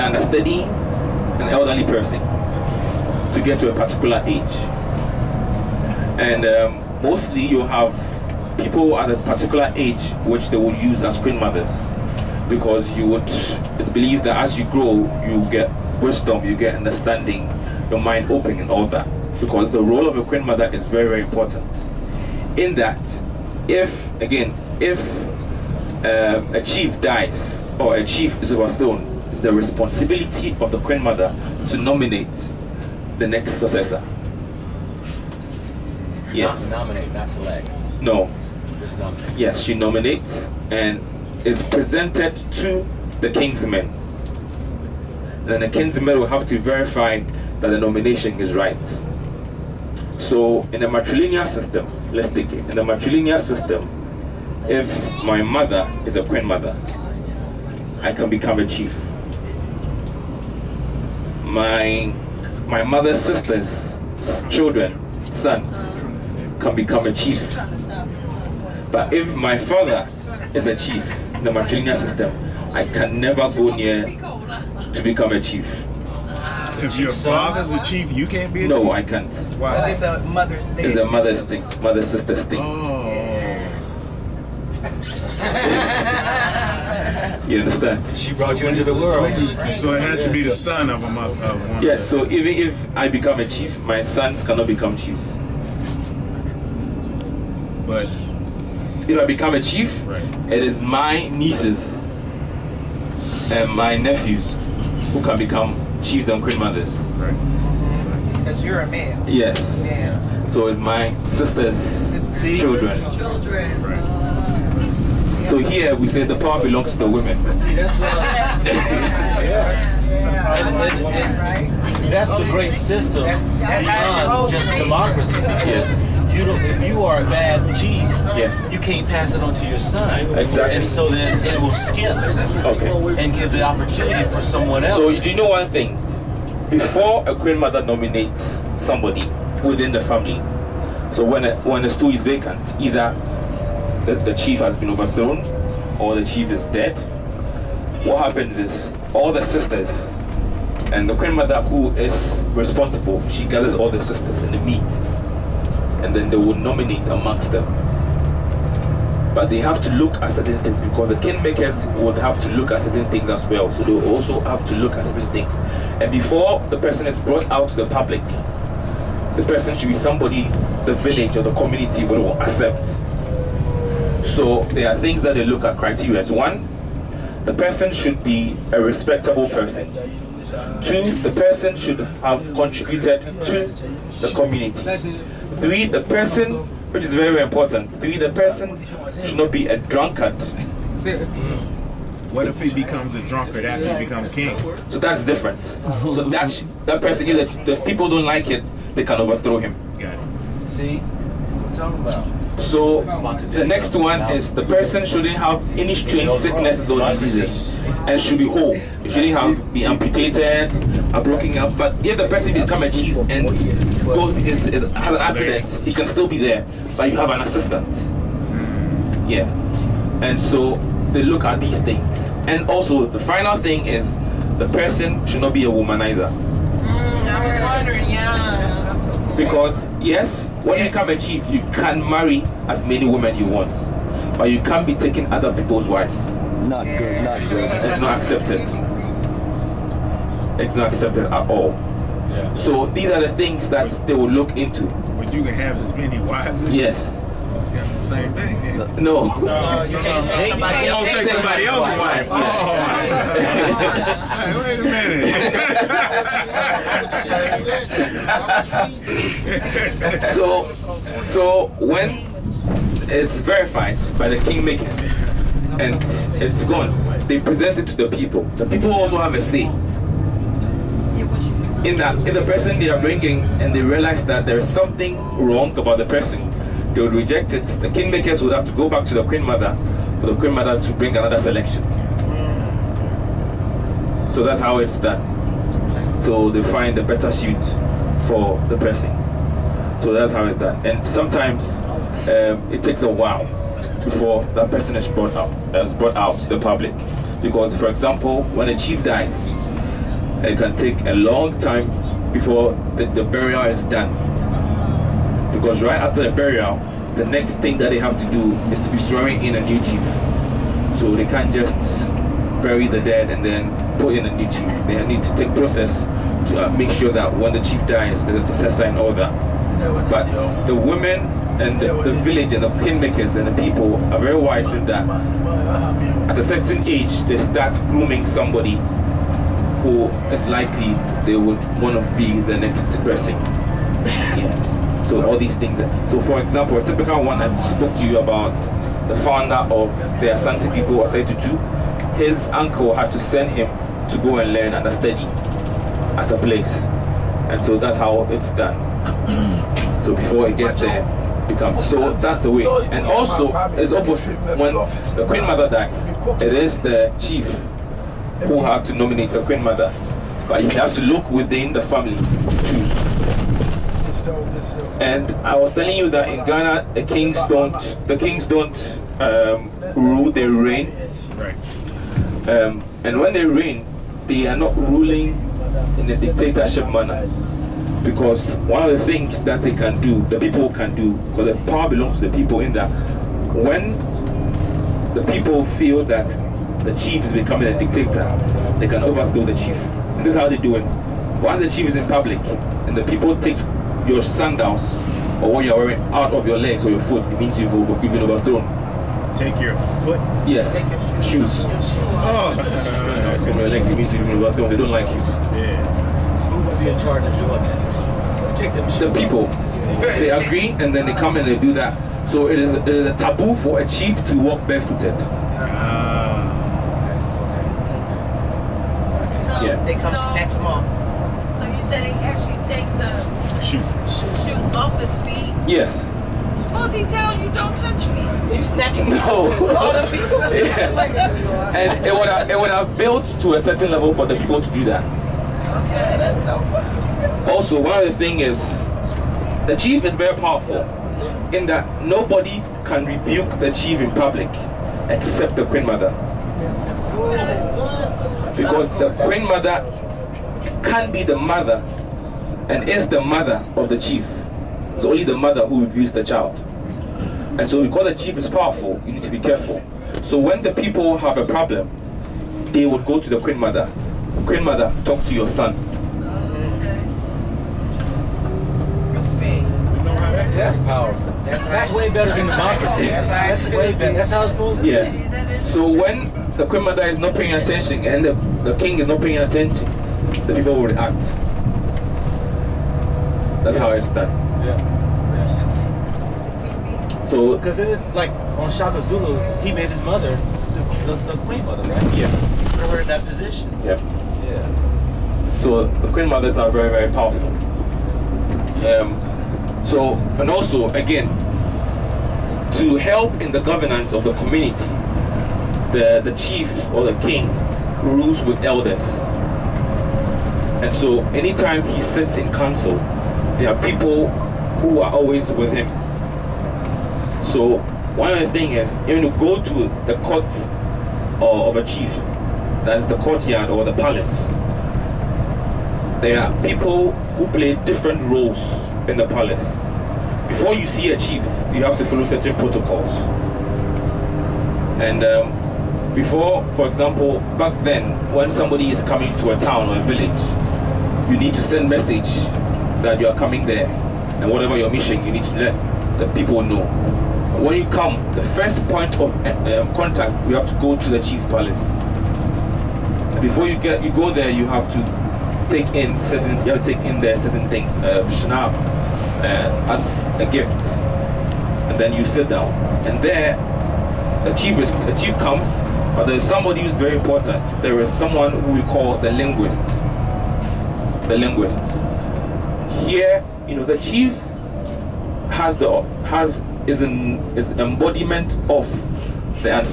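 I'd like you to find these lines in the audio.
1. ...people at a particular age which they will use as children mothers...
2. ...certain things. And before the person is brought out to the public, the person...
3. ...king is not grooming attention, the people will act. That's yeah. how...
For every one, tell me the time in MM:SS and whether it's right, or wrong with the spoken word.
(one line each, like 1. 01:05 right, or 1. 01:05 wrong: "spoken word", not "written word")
1. 00:08 wrong: "queen", not "children"
2. 02:45 right
3. 07:58 wrong: "paying", not "grooming".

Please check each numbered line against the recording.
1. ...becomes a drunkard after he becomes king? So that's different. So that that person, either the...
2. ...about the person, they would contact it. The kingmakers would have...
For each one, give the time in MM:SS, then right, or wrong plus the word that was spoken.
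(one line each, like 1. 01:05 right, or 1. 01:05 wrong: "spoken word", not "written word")
1. 03:12 right
2. 04:35 wrong: "reject", not "contact".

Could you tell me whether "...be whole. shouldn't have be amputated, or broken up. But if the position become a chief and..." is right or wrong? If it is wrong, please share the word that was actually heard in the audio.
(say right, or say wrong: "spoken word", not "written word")
wrong: "person", not "position".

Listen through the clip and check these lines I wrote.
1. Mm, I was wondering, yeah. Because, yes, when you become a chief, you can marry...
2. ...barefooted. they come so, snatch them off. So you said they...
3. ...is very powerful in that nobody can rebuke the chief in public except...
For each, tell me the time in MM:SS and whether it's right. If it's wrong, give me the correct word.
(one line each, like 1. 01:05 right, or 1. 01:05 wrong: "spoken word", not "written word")
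1. 03:46 right
2. 06:54 right
3. 07:20 right.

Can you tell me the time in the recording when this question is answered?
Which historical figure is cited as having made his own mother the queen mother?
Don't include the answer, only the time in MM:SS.
08:08.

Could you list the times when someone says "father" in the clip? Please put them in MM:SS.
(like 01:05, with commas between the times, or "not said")
01:09, 01:17.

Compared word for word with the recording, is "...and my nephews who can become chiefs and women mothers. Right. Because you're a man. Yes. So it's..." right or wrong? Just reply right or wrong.
wrong.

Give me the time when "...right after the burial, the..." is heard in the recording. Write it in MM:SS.
05:05.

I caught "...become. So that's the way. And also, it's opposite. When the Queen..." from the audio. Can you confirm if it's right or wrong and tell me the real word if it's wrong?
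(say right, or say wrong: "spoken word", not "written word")
right.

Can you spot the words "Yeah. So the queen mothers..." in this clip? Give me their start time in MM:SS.
08:14.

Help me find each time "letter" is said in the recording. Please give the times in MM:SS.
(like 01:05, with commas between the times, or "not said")
not said.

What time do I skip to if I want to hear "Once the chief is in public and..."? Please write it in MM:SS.
06:31.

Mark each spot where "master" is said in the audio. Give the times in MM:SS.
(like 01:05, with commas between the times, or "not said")
not said.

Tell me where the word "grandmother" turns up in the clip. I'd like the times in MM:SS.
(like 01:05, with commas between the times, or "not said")
02:17, 02:31, 07:29.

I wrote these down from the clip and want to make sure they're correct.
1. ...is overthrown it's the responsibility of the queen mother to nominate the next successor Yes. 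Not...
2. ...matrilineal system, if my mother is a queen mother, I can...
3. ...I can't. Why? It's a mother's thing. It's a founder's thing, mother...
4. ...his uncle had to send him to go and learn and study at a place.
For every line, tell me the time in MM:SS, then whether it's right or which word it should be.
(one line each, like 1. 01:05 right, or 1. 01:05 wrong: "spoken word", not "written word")
1. 00:28 right
2. 00:52 right
3. 01:18 wrong: "mother", not "founder"
4. 05:42 right.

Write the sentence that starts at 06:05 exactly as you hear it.
And I was telling you that in Ghana, the kings don't, the kings don't um, rule; they reign.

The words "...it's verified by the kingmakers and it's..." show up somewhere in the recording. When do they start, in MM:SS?
04:23.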